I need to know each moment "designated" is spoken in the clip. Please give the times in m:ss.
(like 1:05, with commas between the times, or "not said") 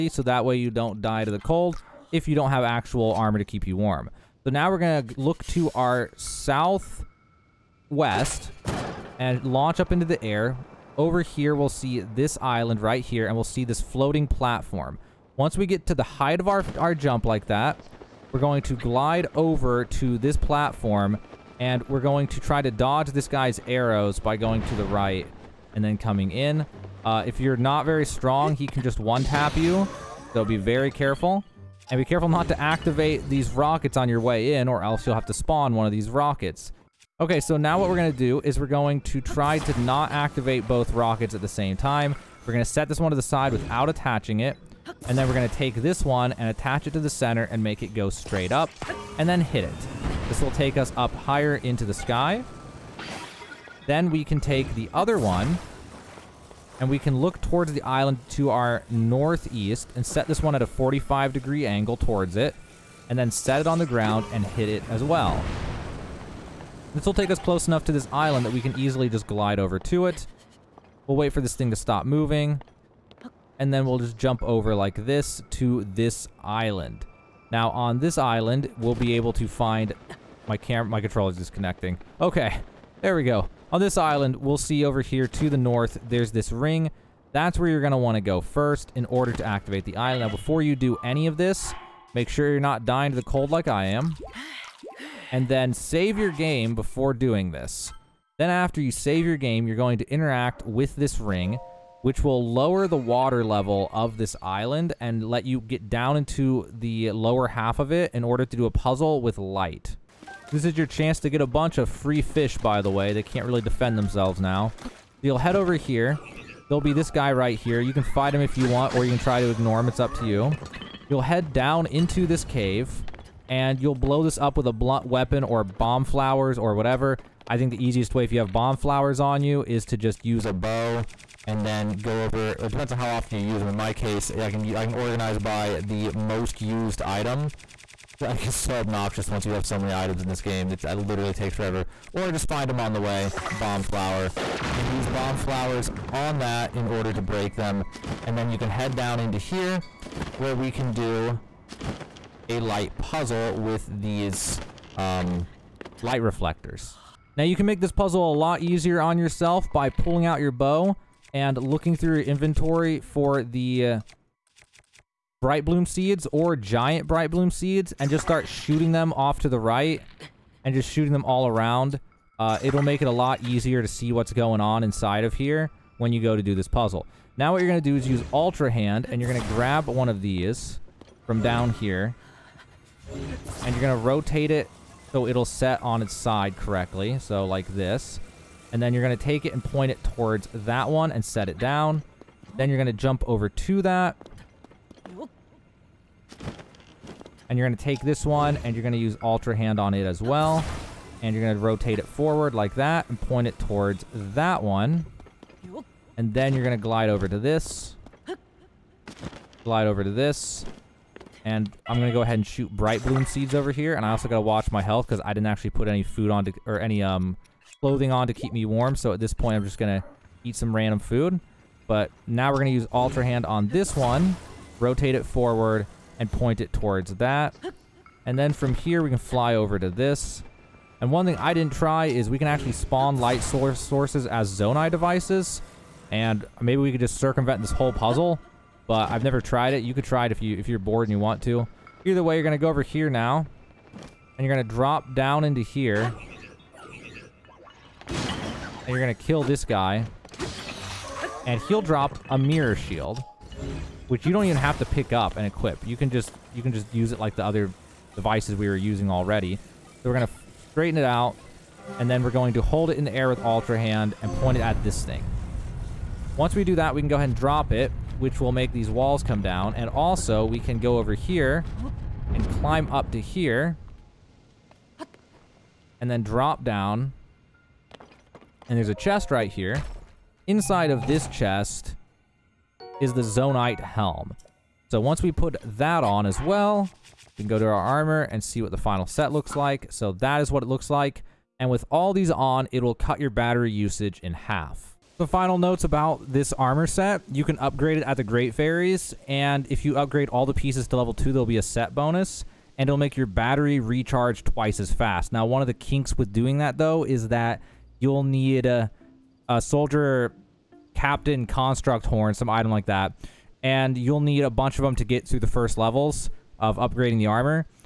not said.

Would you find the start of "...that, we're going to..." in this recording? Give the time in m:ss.
0:17.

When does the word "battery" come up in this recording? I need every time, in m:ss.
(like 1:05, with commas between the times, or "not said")
4:53, 5:03.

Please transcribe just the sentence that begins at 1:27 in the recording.
That's where you're going to want to go first in order to activate the island.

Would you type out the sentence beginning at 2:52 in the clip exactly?
Uh, it'll make it a lot easier to see what's going on inside of here when you go to do this puzzle.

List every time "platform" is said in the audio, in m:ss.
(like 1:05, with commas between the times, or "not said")
0:14, 0:20.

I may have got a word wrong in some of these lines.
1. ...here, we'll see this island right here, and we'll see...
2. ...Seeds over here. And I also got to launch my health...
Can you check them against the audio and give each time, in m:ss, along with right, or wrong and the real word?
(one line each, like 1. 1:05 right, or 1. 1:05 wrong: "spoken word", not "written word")
1. 0:11 right
2. 3:33 wrong: "watch", not "launch".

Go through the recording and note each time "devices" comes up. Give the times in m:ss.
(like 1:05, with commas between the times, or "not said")
3:54, 4:18.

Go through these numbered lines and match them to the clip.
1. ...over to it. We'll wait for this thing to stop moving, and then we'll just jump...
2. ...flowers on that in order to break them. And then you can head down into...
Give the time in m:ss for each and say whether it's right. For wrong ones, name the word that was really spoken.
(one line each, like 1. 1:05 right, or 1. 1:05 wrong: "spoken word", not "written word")
1. 1:09 right
2. 2:25 right.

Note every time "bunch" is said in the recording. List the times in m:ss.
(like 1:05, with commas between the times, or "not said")
1:51, 5:14.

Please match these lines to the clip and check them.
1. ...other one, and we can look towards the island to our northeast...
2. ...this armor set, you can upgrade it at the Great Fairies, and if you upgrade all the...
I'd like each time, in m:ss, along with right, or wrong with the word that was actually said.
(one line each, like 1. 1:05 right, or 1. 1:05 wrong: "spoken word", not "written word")
1. 0:54 right
2. 4:56 right.